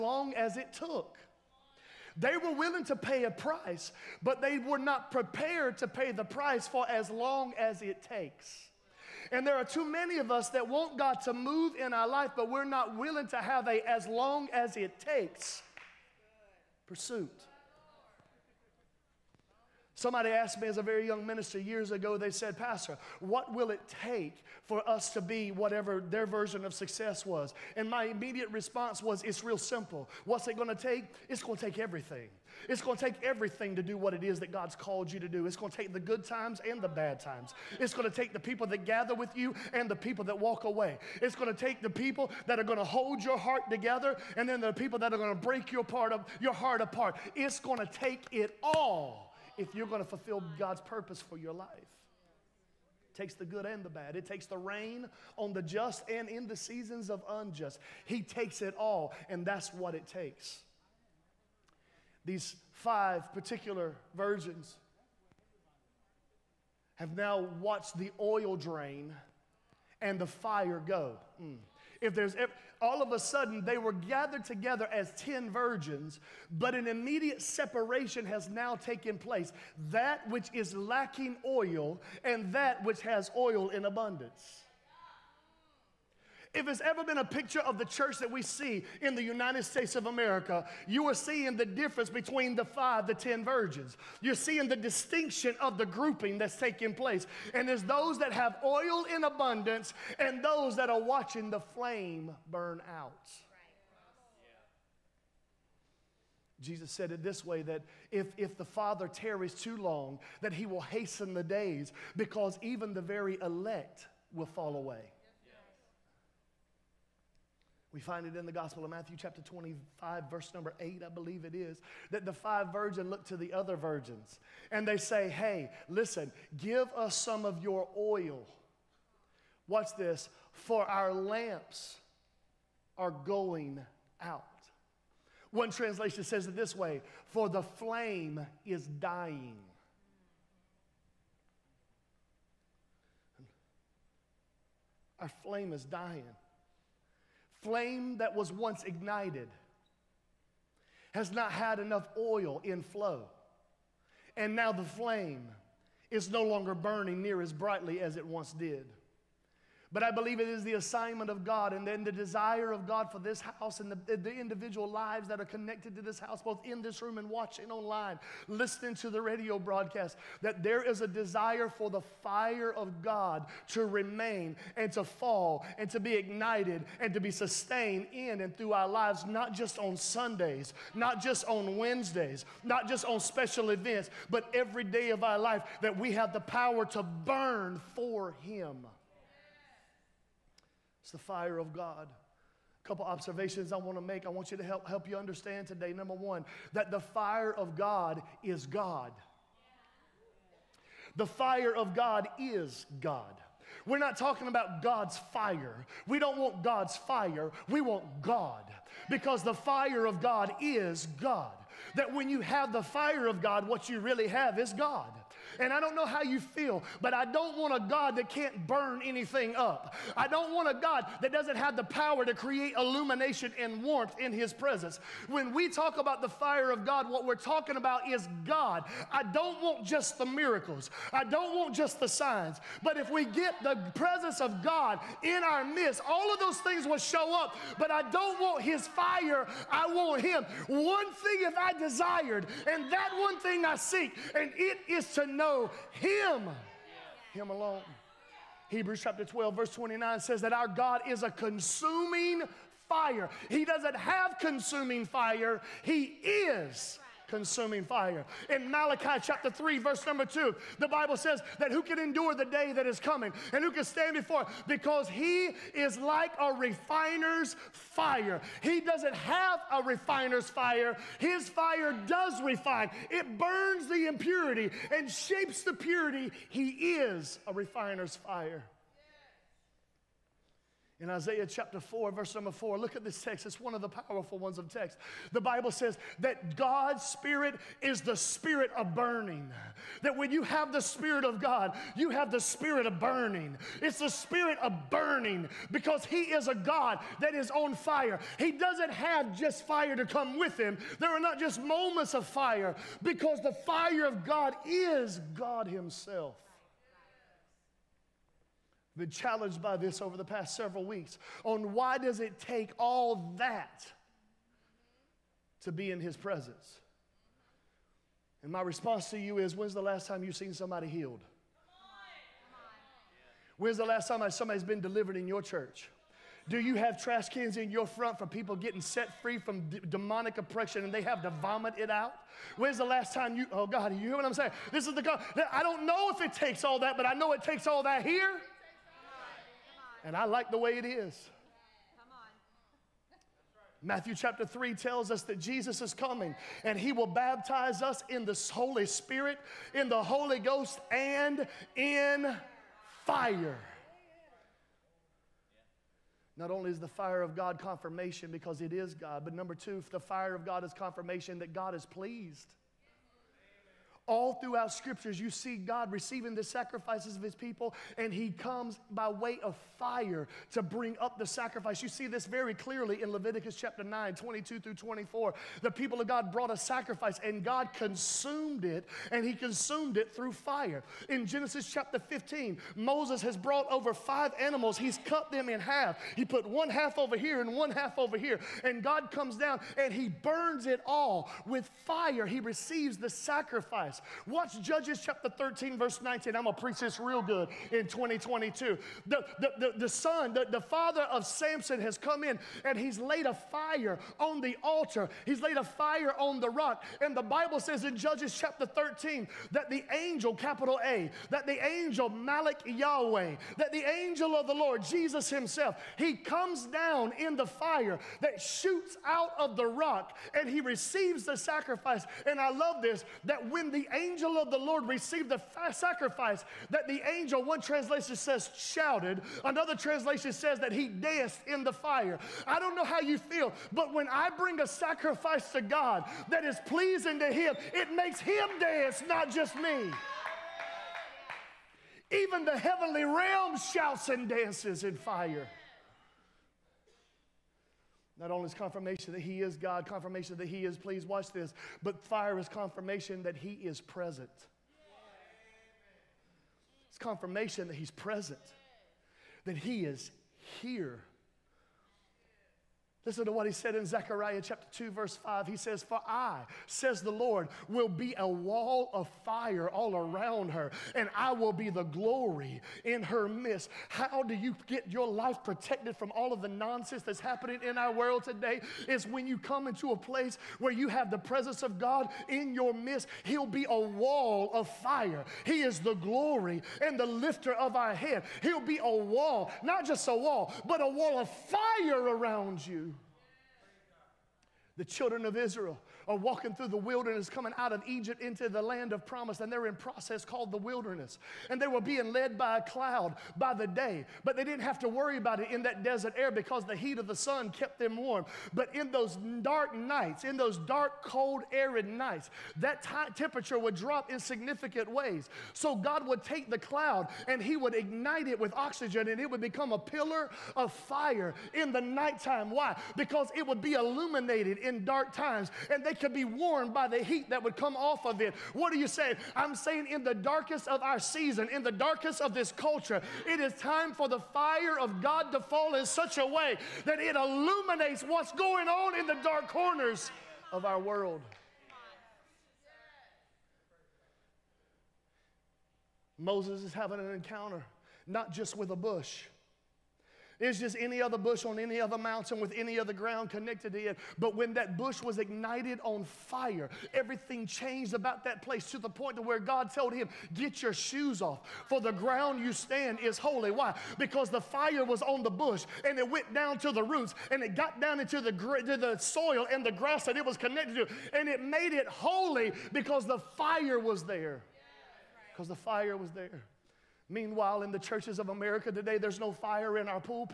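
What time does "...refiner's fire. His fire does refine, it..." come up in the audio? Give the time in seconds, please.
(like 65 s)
269 s.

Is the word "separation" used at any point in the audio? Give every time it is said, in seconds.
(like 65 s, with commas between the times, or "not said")
77 s.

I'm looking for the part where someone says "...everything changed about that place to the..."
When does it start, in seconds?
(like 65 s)
556 s.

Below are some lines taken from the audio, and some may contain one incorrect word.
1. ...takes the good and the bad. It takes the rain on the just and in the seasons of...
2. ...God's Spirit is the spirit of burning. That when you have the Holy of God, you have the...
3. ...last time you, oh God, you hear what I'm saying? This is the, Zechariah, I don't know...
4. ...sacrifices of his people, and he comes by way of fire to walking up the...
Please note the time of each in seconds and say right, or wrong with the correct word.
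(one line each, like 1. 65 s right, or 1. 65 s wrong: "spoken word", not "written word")
1. 53 s right
2. 286 s wrong: "Spirit", not "Holy"
3. 332 s wrong: "God", not "Zechariah"
4. 366 s wrong: "bring", not "walking".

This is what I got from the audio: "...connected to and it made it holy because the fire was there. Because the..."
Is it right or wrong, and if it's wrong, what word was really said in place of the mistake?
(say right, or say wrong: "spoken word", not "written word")
right.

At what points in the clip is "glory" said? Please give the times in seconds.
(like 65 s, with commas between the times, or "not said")
471 s, 485 s.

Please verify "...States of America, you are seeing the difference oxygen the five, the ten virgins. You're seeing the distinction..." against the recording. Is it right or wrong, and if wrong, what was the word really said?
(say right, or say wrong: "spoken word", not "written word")
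wrong: "between", not "oxygen".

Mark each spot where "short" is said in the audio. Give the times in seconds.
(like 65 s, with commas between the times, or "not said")
not said.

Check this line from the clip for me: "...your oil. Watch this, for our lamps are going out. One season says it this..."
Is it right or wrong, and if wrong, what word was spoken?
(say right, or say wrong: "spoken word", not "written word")
wrong: "translation", not "season".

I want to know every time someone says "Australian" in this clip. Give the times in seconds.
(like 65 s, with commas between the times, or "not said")
not said.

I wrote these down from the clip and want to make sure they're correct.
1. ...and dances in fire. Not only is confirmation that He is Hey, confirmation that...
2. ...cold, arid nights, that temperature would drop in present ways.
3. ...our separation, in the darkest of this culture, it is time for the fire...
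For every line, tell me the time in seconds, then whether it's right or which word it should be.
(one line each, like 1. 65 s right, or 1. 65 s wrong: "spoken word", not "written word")
1. 444 s wrong: "God", not "Hey"
2. 511 s wrong: "significant", not "present"
3. 530 s wrong: "season", not "separation".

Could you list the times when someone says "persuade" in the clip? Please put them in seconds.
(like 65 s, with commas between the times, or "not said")
not said.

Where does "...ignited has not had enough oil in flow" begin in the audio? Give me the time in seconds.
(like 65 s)
148 s.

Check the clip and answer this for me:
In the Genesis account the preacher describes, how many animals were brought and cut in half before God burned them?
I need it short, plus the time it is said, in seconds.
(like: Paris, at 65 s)
5, at 383 s.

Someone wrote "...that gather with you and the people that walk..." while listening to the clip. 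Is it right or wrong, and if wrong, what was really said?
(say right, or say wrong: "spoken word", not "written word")
right.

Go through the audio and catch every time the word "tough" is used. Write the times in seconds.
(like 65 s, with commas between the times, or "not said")
not said.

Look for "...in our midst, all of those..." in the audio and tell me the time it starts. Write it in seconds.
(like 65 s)
235 s.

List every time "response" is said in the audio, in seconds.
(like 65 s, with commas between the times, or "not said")
28 s, 318 s.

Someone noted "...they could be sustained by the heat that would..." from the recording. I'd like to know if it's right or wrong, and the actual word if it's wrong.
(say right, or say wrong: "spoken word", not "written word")
wrong: "warmed", not "sustained".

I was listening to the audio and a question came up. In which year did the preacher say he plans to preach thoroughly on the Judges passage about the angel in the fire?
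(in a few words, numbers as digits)
2022.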